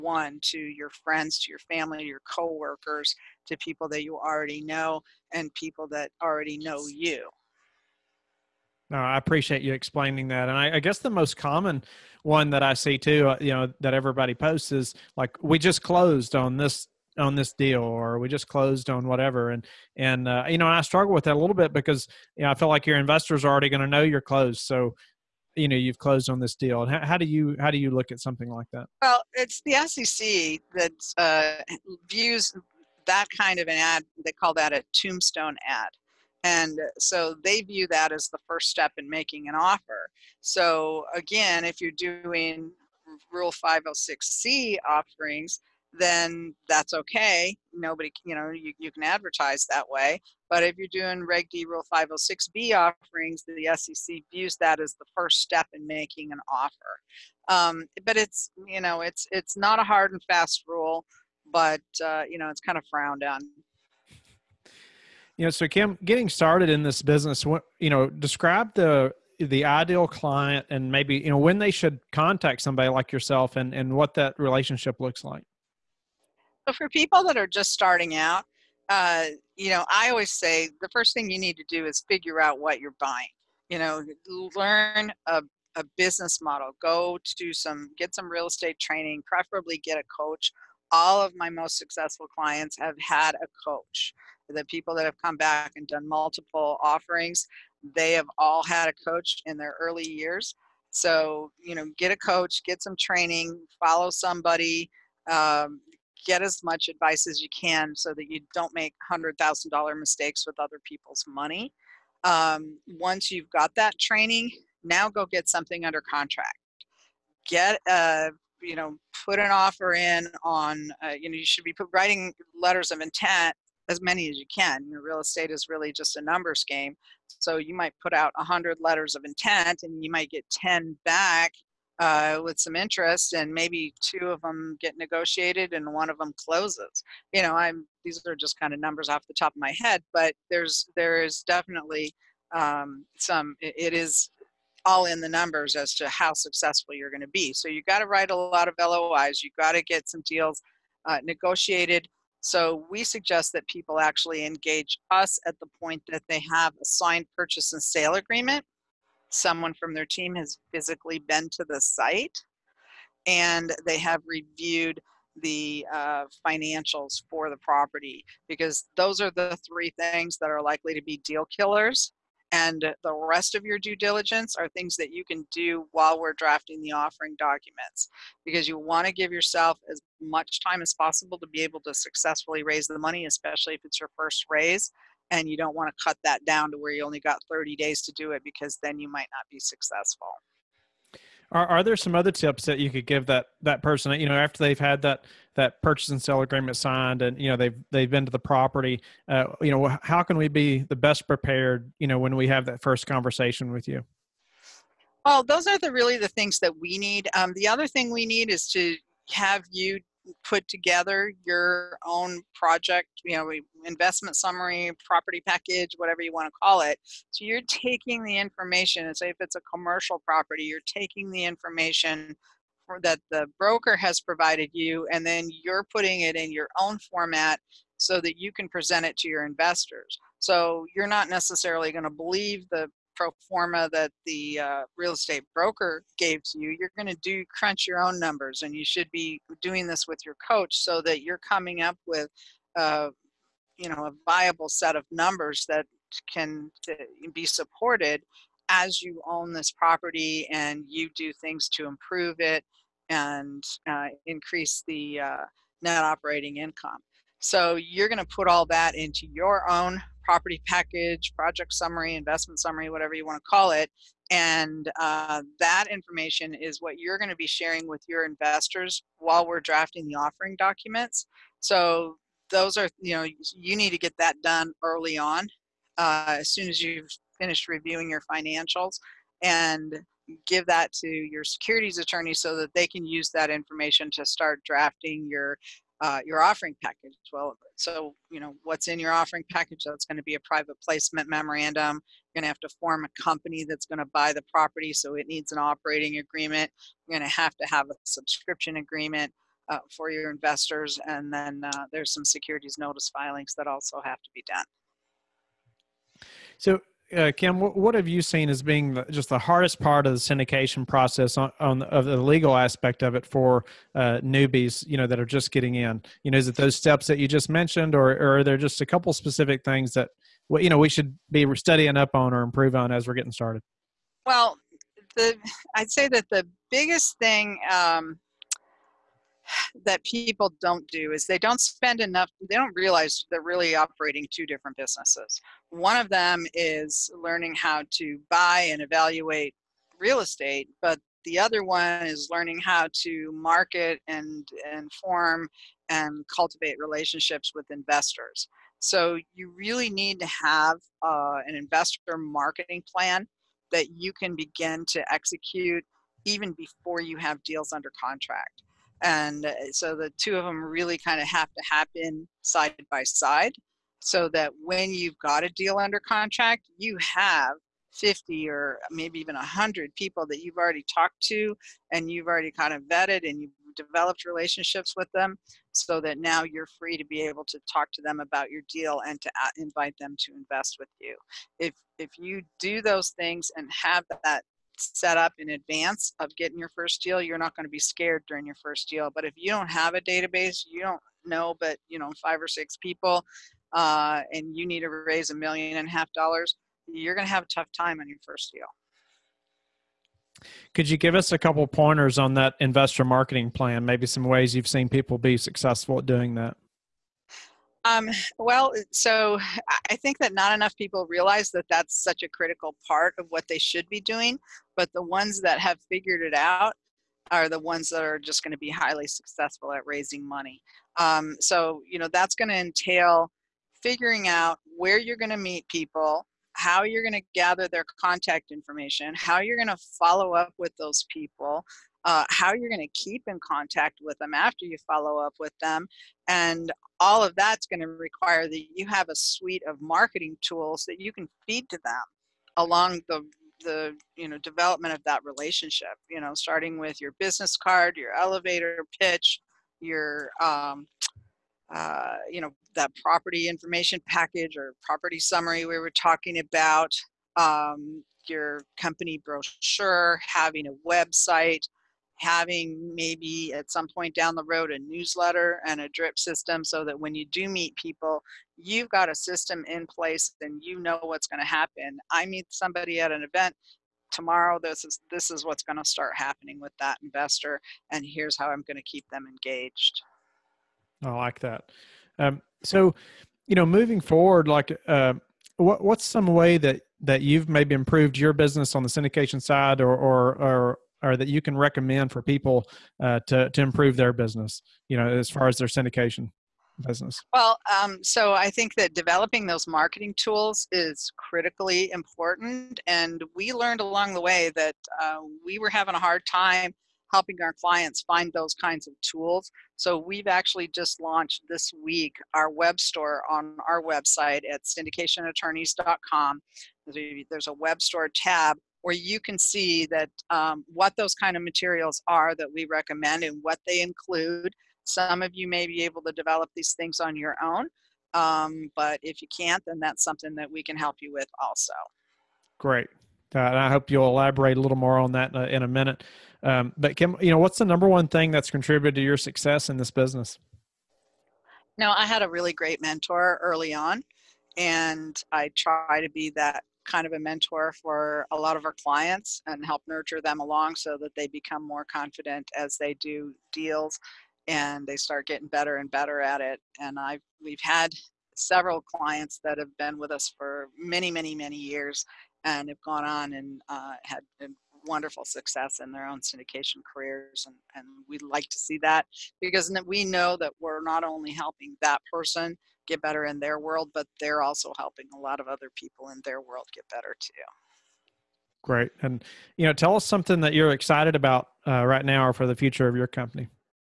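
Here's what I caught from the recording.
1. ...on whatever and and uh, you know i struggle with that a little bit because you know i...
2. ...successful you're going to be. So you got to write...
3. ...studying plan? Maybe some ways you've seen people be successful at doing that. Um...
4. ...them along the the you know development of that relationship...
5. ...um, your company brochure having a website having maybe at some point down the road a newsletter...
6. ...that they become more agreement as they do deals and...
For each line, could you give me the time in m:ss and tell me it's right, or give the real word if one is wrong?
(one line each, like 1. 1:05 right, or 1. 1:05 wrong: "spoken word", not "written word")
1. 0:18 right
2. 2:26 right
3. 6:43 wrong: "marketing", not "studying"
4. 7:21 right
5. 7:37 right
6. 9:11 wrong: "confident", not "agreement".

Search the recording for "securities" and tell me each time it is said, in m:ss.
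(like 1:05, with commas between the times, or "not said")
4:41, 5:02.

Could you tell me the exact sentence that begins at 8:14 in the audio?
You know, as far as their syndication business.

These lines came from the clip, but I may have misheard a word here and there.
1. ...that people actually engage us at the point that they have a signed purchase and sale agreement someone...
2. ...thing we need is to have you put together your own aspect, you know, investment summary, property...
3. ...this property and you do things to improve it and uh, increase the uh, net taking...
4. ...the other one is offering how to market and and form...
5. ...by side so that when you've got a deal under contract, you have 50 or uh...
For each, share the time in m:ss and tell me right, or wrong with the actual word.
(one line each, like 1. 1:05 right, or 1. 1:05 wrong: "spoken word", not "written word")
1. 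2:33 right
2. 3:27 wrong: "project", not "aspect"
3. 4:09 wrong: "operating", not "taking"
4. 5:41 wrong: "learning", not "offering"
5. 6:02 right.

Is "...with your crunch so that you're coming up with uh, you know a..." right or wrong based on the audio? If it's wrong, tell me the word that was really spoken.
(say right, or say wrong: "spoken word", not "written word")
wrong: "coach", not "crunch".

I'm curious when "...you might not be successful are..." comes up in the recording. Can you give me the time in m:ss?
3:08.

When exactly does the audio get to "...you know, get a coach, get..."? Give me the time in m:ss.
1:41.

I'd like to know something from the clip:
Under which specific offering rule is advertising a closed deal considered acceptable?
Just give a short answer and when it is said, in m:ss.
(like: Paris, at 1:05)
Rule 506c, at 0:43.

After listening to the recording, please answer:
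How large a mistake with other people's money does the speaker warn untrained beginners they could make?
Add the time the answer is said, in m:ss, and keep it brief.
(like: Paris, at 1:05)
$100,000, at 1:49.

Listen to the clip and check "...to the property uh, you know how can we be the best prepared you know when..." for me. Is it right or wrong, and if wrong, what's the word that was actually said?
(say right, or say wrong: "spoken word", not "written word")
right.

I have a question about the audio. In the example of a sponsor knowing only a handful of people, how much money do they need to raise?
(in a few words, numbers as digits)
$1.5 million.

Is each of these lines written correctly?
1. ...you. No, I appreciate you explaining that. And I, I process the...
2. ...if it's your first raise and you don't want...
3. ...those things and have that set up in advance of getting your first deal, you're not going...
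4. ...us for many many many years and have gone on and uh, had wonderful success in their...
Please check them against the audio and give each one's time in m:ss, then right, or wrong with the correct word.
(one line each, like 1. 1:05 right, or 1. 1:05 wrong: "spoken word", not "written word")
1. 0:06 wrong: "guess", not "process"
2. 3:03 right
3. 6:22 right
4. 9:20 right.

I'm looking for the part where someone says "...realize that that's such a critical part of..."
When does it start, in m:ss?
6:51.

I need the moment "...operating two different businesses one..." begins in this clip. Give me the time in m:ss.
5:33.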